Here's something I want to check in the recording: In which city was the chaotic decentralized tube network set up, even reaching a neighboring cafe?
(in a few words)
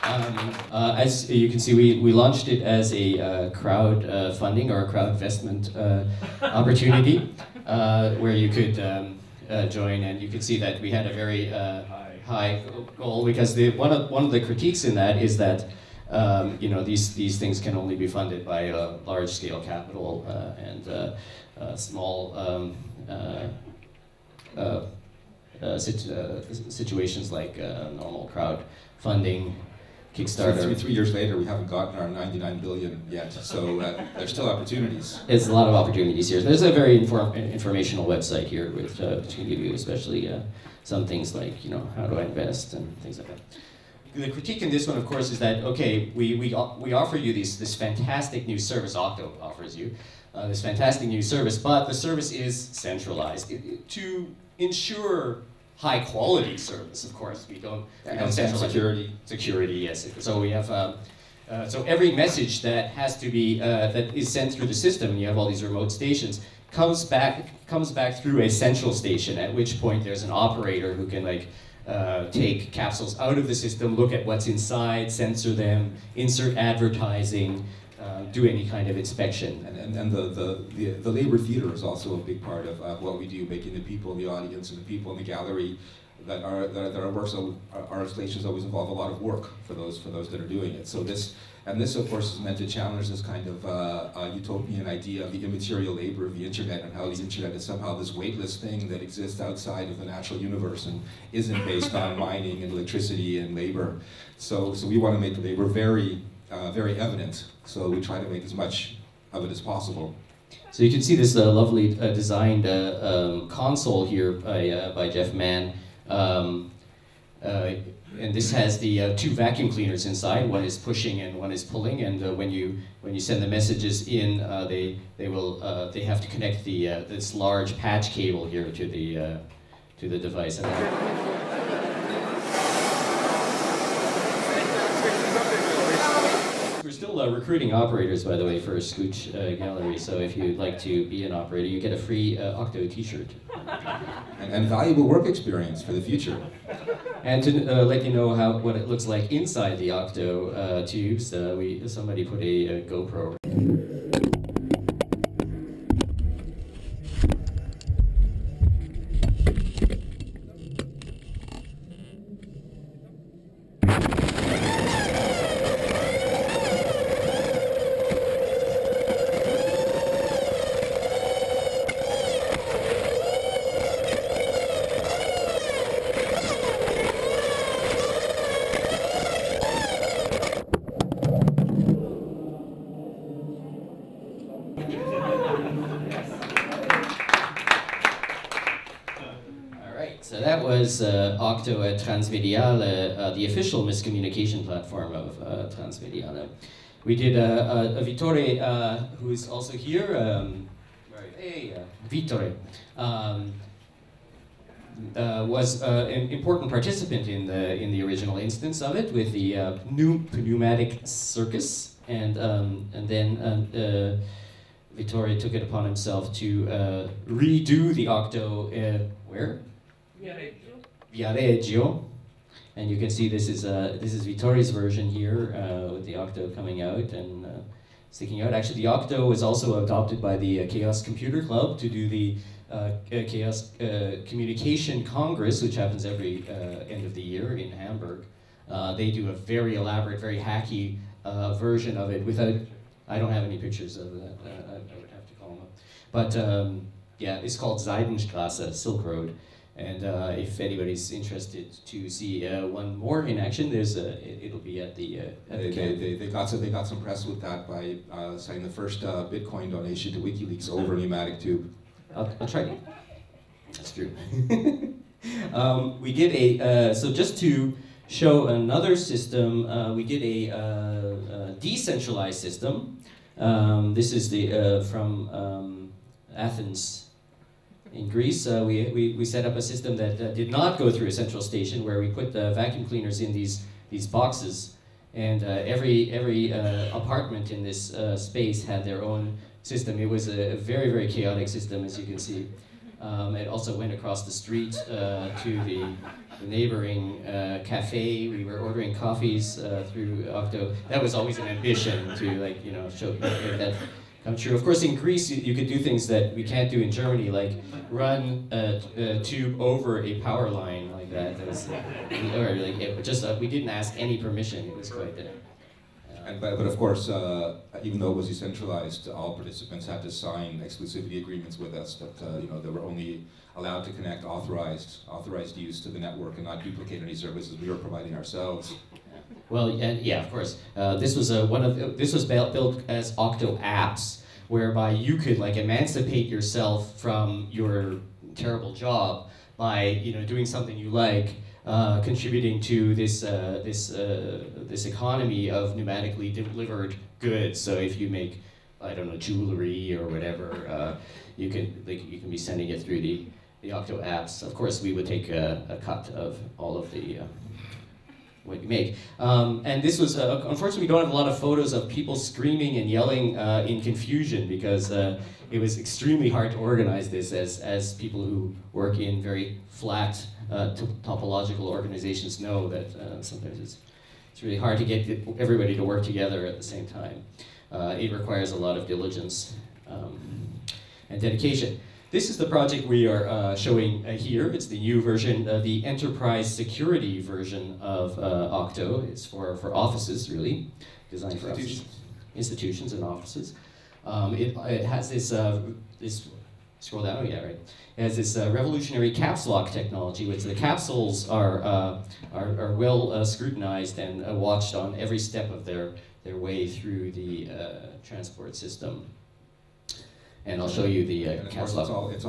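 Athens.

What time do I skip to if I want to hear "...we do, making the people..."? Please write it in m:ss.
1:23.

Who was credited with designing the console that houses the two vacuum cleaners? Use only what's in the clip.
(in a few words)
Jeff Mann.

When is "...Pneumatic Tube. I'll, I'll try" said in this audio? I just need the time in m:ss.
4:20.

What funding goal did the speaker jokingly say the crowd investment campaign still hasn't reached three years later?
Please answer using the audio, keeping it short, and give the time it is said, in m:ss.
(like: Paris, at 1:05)
99 billion, at 0:32.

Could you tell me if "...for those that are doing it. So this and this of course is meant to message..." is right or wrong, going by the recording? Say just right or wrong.
wrong.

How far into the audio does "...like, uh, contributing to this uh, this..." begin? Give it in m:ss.
5:40.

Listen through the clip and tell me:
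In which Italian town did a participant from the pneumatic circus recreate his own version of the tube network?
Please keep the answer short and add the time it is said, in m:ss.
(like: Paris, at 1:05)
Viareggio, at 3:41.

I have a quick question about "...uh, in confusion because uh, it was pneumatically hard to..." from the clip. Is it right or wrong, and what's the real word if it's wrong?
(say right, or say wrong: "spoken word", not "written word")
wrong: "extremely", not "pneumatically".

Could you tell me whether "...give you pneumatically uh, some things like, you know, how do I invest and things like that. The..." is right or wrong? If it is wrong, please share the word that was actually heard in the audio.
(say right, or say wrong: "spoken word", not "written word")
wrong: "especially", not "pneumatically".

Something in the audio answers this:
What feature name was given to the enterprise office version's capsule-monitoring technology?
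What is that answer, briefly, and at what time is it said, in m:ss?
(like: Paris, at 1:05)
caps lock technology, at 6:39.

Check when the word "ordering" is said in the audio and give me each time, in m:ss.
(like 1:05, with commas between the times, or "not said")
4:58.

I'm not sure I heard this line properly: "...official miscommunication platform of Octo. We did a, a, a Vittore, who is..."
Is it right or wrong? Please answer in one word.
wrong.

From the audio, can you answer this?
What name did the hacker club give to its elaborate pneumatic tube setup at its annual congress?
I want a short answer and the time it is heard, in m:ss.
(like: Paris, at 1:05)
Seidenstrasse, at 4:07.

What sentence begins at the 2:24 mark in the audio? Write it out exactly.
And, and, valuable work experience for the future.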